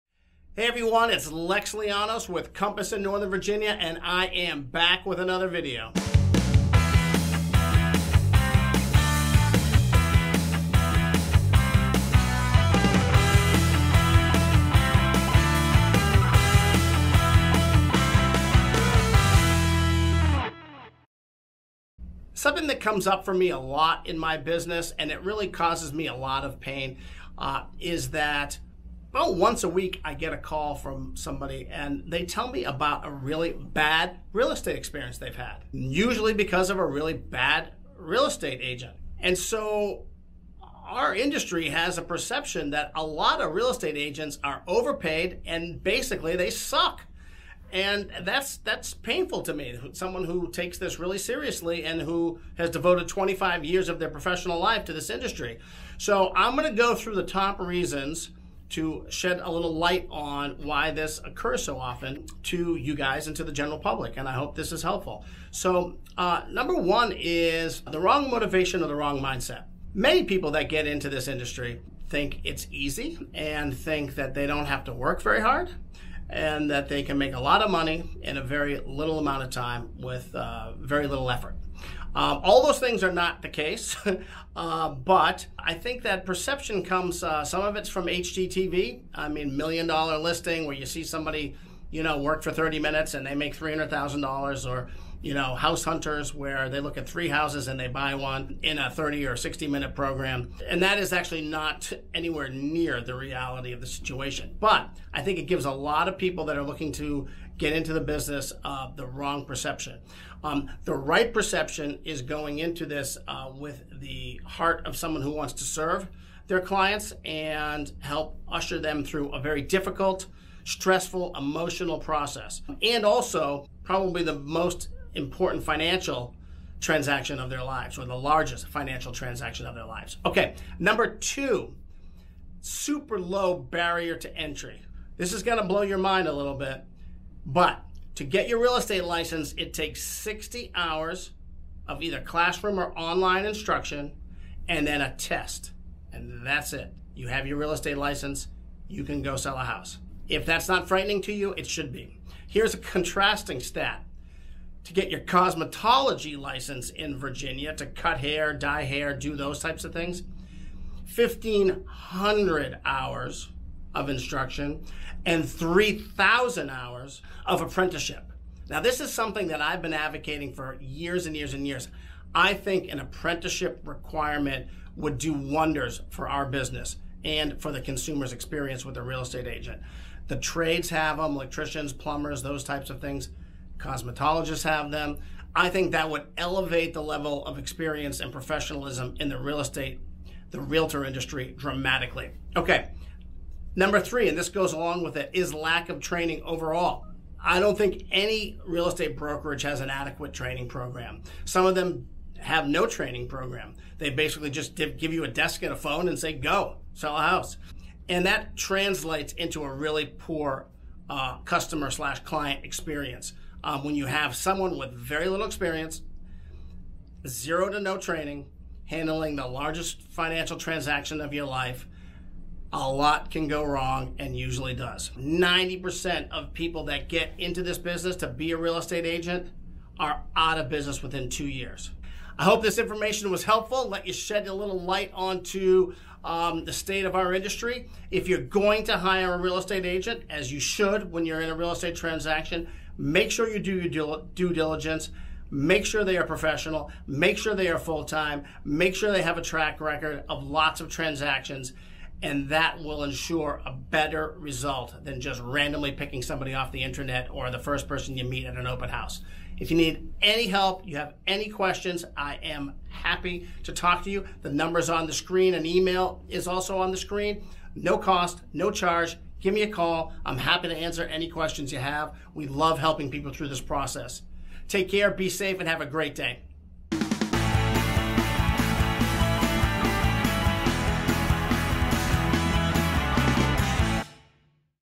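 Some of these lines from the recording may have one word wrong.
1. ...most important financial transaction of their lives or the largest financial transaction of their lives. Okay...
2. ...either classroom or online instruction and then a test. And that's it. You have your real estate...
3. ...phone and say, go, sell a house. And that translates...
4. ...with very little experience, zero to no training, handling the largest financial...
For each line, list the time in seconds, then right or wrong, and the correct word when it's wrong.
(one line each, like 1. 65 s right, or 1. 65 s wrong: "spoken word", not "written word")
1. 124 s right
2. 142 s right
3. 205 s right
4. 214 s right.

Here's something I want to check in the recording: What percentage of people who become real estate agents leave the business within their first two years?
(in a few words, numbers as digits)
90%.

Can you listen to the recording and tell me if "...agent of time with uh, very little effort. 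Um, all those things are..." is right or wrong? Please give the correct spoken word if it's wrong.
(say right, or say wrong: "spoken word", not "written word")
wrong: "amount", not "agent".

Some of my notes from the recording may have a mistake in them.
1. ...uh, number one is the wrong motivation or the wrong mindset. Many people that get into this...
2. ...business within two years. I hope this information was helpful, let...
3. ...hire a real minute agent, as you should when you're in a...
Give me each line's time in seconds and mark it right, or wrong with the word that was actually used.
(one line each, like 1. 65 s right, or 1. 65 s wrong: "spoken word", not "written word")
1. 66 s right
2. 230 s right
3. 238 s wrong: "estate", not "minute".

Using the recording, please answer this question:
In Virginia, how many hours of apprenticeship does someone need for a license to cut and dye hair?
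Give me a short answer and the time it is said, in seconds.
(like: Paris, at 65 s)
3,000 hours, at 165 s.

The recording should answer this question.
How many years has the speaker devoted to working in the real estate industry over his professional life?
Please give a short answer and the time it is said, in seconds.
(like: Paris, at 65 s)
25 years, at 53 s.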